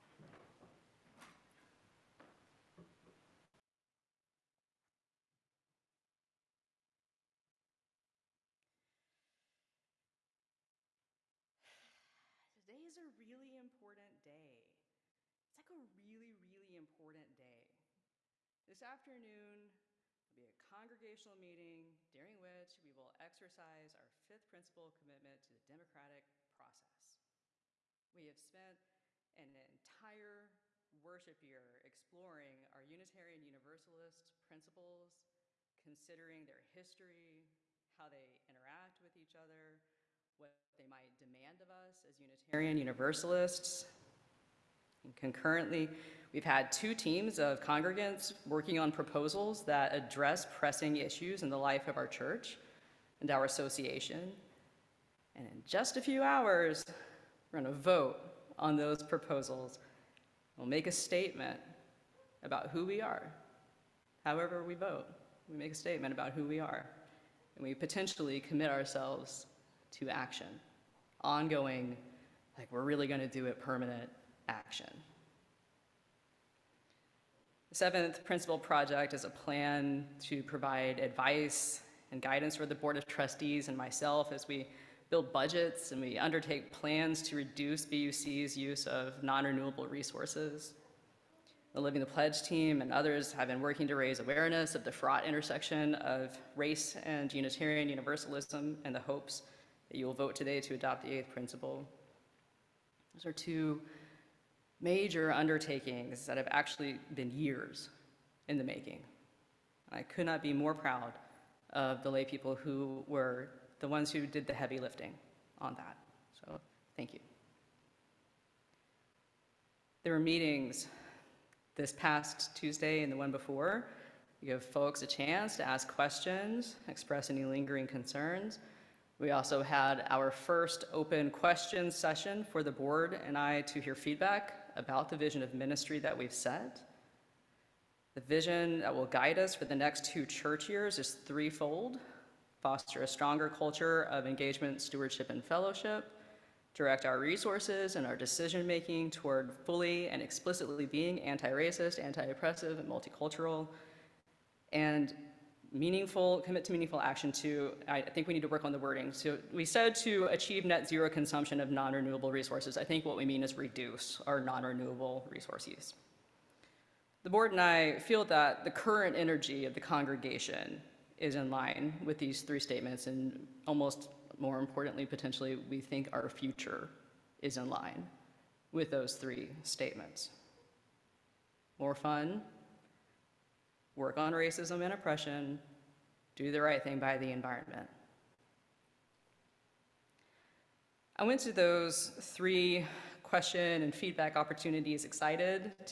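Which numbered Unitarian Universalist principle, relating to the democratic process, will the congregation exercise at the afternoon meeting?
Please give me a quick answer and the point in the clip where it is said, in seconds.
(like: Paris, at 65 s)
fifth principle, at 24 s.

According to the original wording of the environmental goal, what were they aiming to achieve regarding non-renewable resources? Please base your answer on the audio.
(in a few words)
net zero consumption.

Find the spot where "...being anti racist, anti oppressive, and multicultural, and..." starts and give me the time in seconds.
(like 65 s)
150 s.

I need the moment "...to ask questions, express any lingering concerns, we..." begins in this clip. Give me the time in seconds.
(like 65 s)
125 s.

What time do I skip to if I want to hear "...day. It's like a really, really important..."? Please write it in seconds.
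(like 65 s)
14 s.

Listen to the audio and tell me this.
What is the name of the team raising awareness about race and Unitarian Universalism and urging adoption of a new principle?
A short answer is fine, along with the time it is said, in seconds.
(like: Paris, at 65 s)
Living the Pledge, at 91 s.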